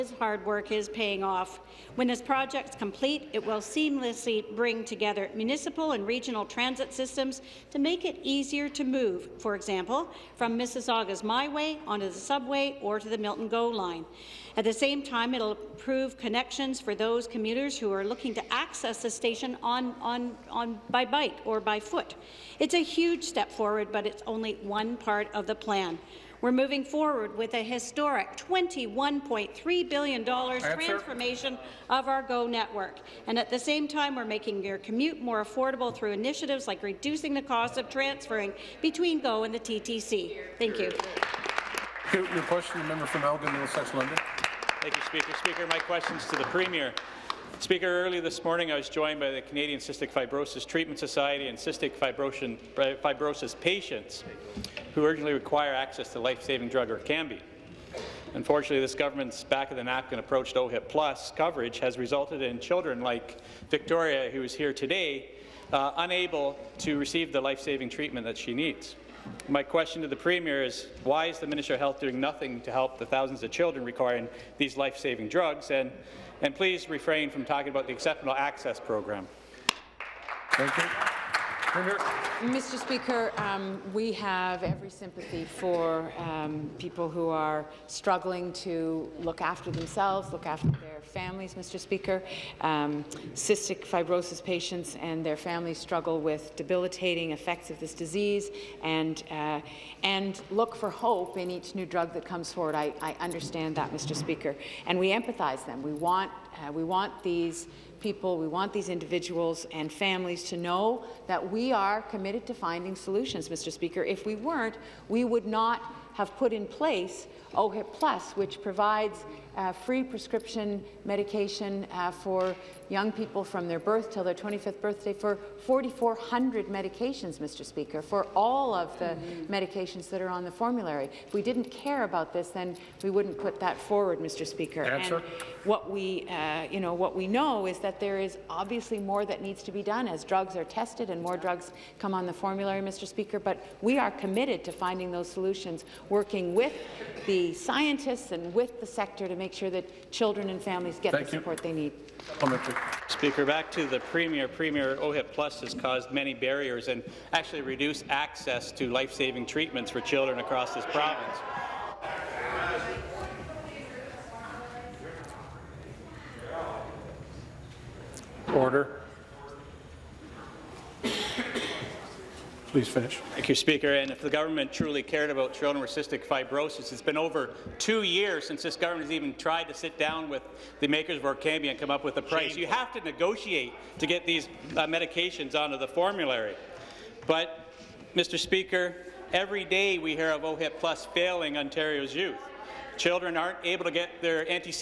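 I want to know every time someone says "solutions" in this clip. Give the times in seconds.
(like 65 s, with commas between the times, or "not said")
112 s, 145 s.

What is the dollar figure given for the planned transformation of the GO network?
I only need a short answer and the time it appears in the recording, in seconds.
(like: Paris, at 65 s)
$21.3 billion, at 28 s.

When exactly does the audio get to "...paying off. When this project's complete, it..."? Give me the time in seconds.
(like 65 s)
0 s.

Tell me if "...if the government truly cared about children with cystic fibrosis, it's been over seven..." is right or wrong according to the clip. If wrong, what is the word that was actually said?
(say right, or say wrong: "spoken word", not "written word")
wrong: "two", not "seven".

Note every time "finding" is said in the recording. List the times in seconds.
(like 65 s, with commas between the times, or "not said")
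112 s, 144 s.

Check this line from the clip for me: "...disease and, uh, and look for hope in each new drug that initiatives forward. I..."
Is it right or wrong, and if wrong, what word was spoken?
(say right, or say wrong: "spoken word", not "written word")
wrong: "comes", not "initiatives".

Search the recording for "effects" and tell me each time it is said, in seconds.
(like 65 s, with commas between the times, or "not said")
97 s.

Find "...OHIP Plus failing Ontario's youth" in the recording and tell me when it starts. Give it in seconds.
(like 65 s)
190 s.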